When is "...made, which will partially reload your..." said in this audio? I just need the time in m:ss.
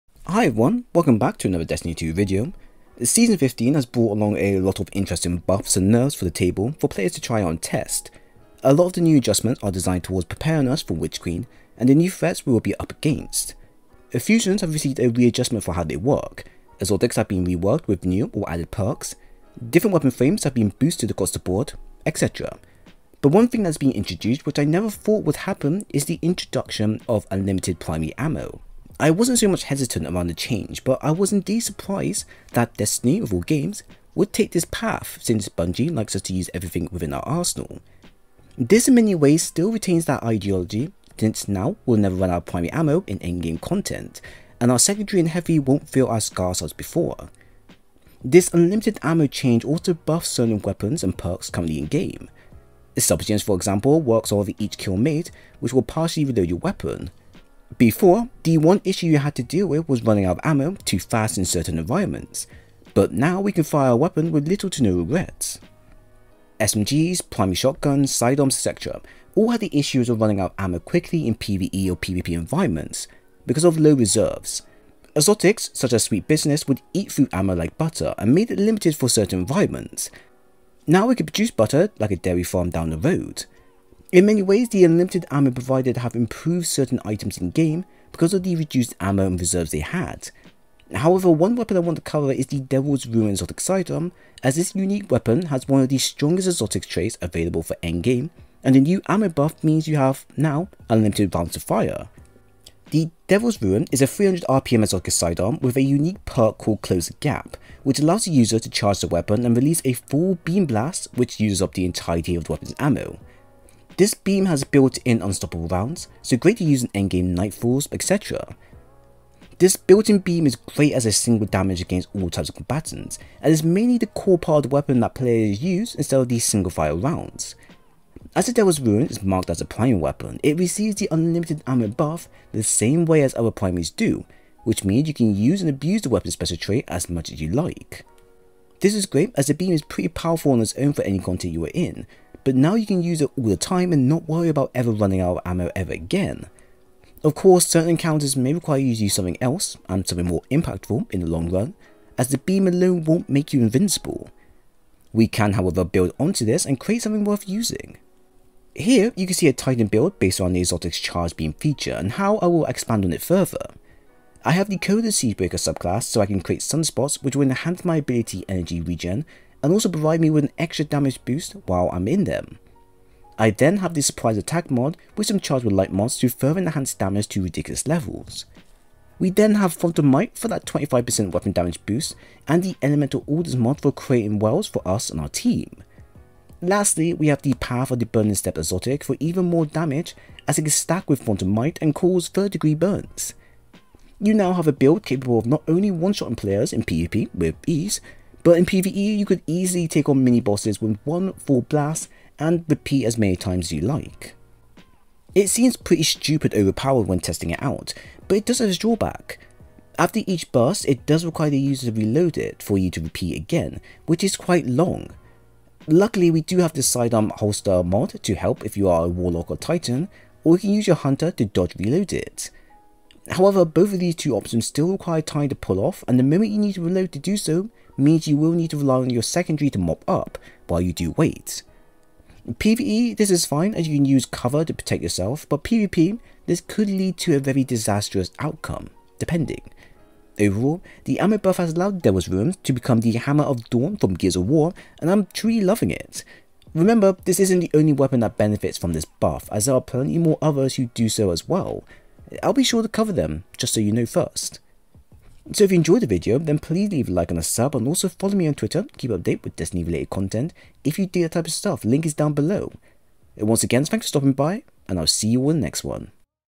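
0:54.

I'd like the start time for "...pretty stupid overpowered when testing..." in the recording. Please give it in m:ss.
3:25.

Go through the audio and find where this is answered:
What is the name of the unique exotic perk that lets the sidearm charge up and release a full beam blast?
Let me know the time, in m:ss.
1:46.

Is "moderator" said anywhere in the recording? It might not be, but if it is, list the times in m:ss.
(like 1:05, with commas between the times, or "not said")
not said.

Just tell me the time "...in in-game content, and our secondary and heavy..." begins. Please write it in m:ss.
0:43.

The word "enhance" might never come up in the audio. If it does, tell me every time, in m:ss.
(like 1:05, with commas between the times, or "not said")
2:47, 2:56.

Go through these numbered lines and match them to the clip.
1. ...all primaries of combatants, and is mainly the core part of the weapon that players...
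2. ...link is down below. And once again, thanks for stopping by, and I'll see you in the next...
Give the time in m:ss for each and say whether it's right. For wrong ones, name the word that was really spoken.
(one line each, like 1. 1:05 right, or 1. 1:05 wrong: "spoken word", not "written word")
1. 2:02 wrong: "types", not "primaries"
2. 4:21 right.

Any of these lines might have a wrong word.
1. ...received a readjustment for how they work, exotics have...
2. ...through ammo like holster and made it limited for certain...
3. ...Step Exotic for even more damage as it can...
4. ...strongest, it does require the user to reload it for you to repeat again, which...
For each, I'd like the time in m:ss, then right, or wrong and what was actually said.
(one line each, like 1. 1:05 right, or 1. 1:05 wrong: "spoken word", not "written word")
1. 0:14 right
2. 1:17 wrong: "butter", not "holster"
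3. 3:08 right
4. 3:30 wrong: "burst", not "strongest".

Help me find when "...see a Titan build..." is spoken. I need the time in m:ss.
2:39.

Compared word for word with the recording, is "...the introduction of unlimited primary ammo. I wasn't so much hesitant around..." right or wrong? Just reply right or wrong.
right.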